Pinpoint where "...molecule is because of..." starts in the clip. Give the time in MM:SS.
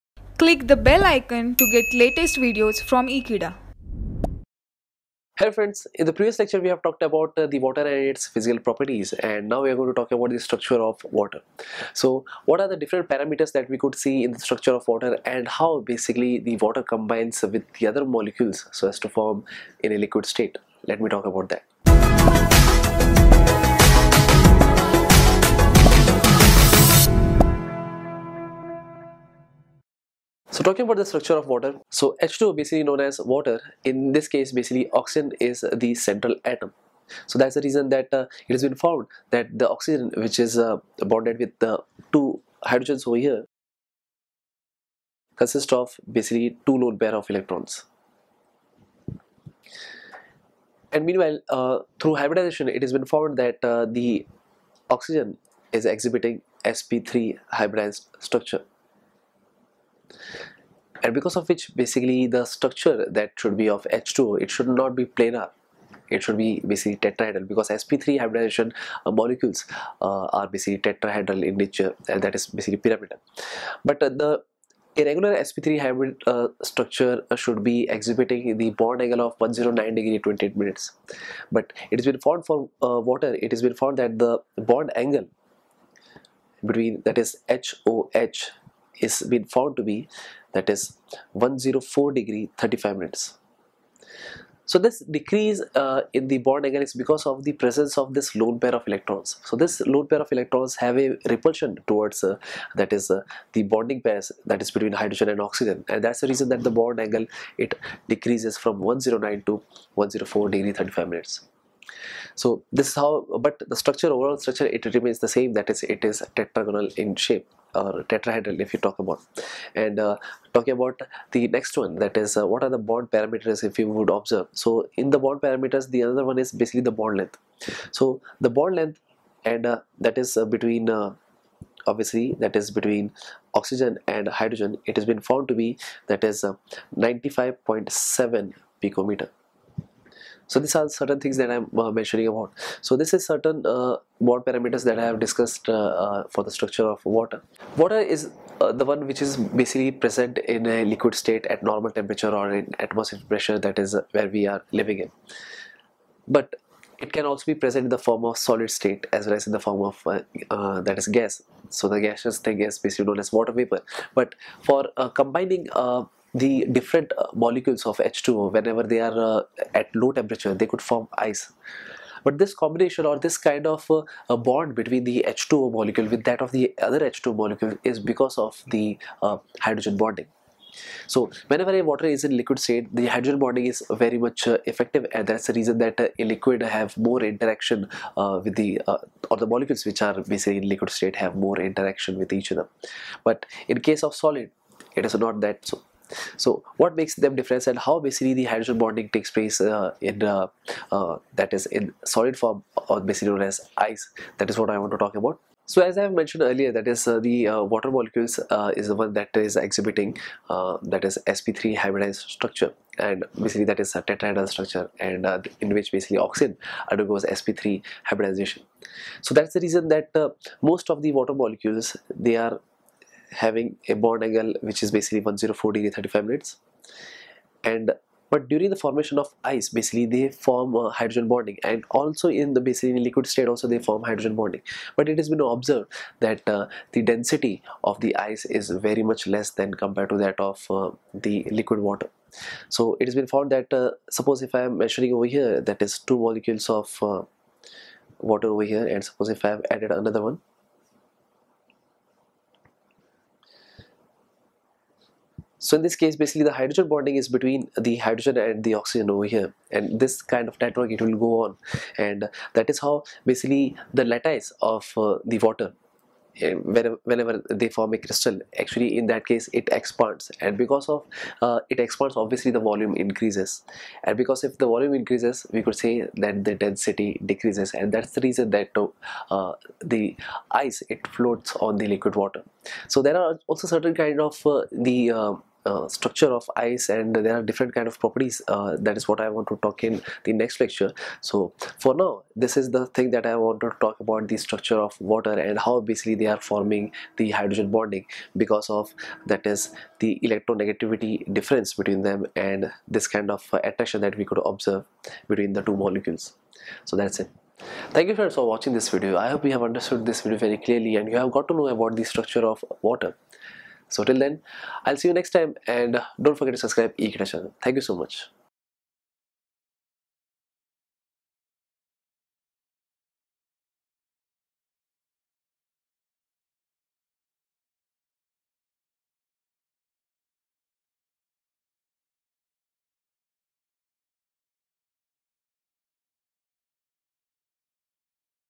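02:57.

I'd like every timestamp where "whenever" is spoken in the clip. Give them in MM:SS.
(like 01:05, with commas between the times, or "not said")
02:48, 03:01, 04:26.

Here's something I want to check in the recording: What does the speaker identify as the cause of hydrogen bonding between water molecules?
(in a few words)
electronegativity difference.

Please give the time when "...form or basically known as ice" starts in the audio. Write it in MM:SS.
03:22.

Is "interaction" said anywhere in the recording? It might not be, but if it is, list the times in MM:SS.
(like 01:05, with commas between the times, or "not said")
03:07, 03:11.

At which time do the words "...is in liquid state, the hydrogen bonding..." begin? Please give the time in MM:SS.
03:02.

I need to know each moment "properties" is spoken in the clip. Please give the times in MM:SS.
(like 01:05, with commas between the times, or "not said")
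00:08, 04:47.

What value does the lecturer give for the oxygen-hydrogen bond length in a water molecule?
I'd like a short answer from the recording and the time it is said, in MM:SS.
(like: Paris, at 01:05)
95.7 picometers, at 02:16.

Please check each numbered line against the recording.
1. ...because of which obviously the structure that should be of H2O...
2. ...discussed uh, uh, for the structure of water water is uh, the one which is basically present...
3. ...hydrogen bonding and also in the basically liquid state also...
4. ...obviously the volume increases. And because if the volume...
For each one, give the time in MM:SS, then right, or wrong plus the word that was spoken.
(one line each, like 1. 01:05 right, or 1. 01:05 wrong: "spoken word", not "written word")
1. 01:01 wrong: "basically", not "obviously"
2. 02:25 right
3. 03:50 right
4. 04:32 right.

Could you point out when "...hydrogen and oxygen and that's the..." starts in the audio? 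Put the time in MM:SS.
01:44.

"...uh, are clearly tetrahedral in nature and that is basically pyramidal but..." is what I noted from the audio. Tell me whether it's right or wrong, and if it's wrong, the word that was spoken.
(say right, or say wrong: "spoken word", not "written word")
wrong: "basically", not "clearly".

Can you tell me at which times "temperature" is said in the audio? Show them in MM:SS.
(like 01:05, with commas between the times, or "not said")
02:31, 02:50.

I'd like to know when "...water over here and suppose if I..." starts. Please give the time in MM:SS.
04:08.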